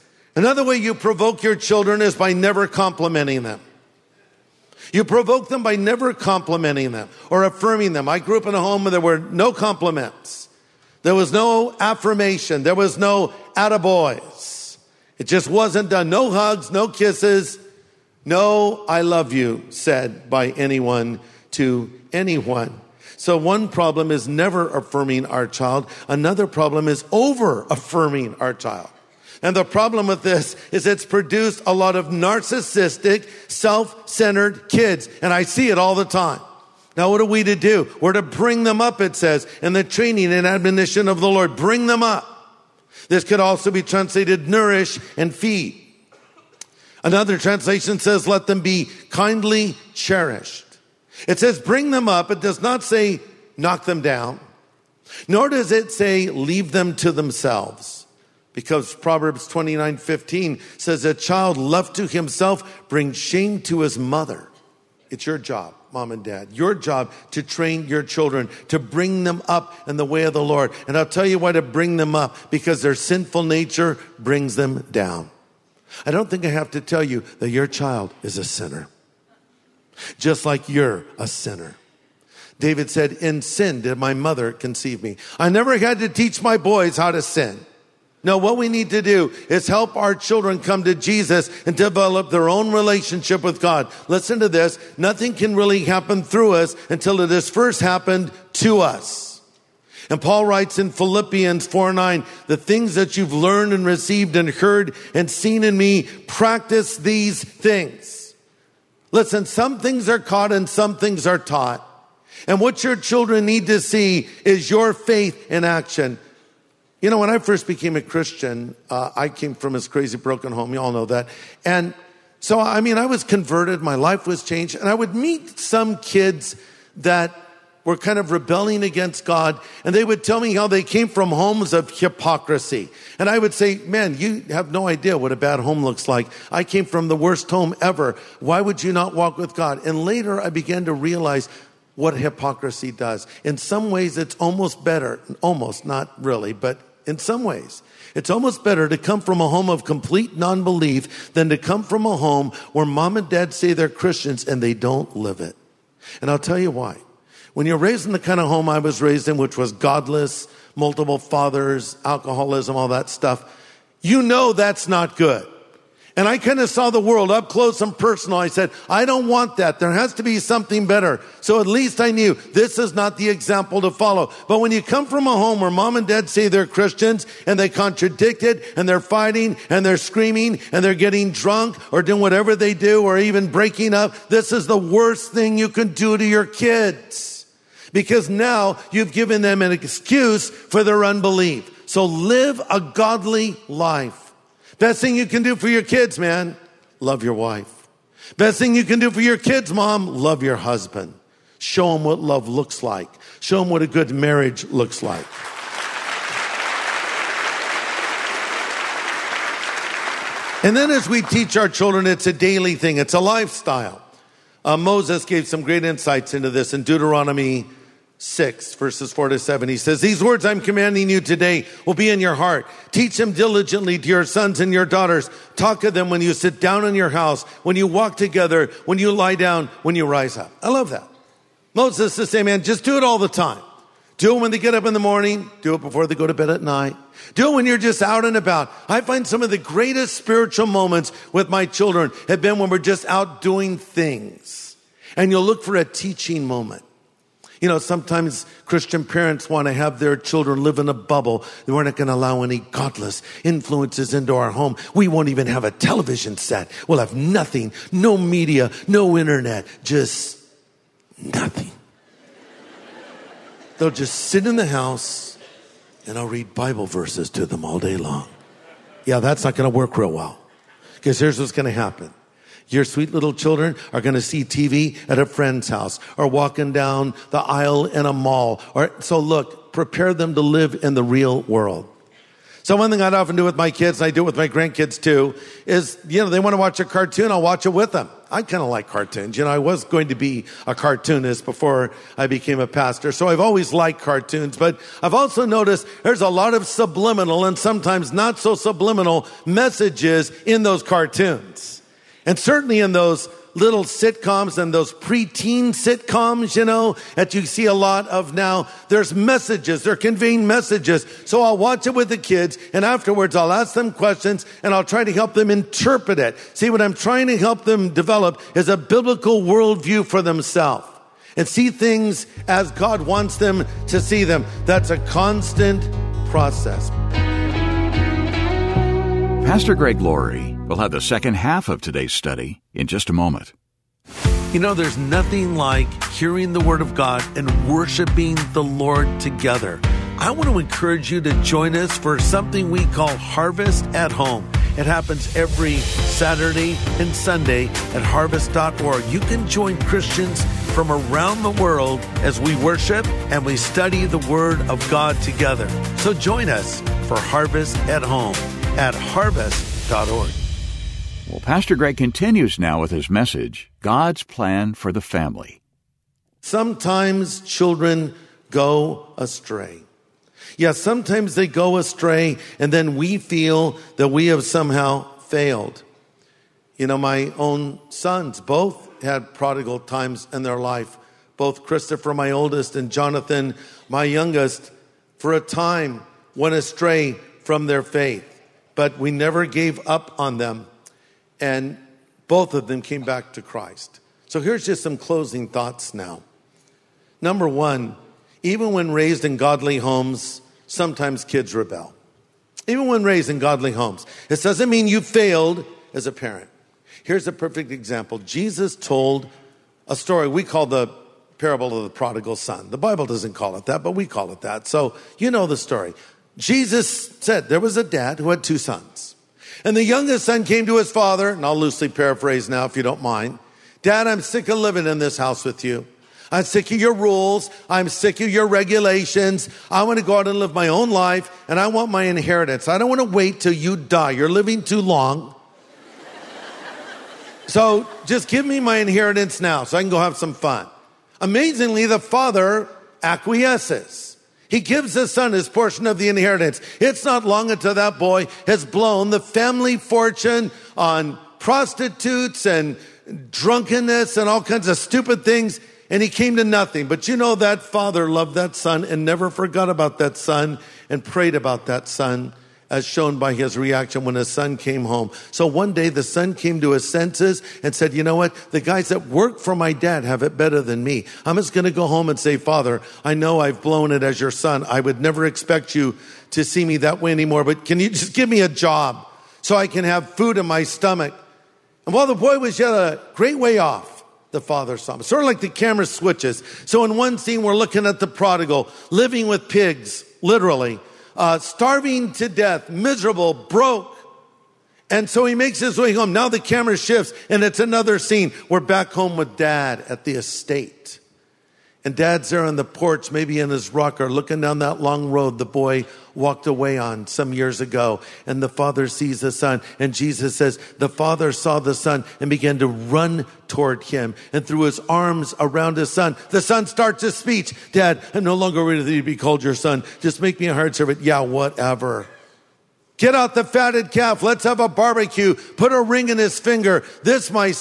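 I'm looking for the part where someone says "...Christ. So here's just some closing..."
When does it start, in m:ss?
6:33.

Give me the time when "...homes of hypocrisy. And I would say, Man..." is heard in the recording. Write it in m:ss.
2:11.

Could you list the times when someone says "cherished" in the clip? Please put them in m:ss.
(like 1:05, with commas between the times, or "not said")
0:49.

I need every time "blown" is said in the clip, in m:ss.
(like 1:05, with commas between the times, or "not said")
7:28, 7:53.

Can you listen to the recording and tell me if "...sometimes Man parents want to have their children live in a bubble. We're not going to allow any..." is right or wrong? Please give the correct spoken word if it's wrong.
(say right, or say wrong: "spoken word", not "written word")
wrong: "Christian", not "Man".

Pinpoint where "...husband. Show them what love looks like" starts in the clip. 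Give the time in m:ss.
3:20.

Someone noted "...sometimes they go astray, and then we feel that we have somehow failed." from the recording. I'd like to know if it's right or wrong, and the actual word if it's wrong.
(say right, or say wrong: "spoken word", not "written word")
right.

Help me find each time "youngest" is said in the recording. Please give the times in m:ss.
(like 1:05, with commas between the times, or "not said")
6:24, 6:59.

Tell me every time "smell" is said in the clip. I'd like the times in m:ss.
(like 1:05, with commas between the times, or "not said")
not said.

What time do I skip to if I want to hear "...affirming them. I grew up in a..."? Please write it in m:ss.
0:07.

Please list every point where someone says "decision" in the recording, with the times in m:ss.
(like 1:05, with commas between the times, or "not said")
not said.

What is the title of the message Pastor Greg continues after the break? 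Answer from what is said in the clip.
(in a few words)
God's Plan for the Family.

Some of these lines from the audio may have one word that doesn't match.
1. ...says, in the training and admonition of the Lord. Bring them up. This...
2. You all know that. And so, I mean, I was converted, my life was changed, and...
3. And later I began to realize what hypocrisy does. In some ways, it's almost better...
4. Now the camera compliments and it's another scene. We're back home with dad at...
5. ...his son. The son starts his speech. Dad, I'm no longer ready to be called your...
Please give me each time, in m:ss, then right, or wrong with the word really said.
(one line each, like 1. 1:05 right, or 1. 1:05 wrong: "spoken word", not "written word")
1. 0:39 right
2. 2:00 right
3. 2:19 right
4. 8:16 wrong: "shifts", not "compliments"
5. 8:35 right.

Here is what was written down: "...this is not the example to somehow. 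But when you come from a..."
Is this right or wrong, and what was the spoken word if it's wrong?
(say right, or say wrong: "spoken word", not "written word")
wrong: "follow", not "somehow".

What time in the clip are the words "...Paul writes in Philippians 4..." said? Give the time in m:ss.
1:40.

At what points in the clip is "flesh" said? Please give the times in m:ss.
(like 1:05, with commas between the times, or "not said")
not said.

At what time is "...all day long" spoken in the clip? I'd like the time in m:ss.
4:27.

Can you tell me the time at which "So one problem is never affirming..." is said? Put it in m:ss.
0:23.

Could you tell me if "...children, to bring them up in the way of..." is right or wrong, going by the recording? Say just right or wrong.
right.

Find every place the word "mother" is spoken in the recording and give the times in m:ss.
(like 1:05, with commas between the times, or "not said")
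1:03, 1:24.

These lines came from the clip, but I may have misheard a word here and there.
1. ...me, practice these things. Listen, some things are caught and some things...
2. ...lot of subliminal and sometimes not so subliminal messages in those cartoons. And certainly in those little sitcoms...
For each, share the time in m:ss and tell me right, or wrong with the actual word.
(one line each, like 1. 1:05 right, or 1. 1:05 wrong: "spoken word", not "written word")
1. 1:45 right
2. 4:56 right.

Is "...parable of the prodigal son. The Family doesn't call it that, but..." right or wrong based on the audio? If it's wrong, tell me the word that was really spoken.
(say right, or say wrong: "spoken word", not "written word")
wrong: "Bible", not "Family".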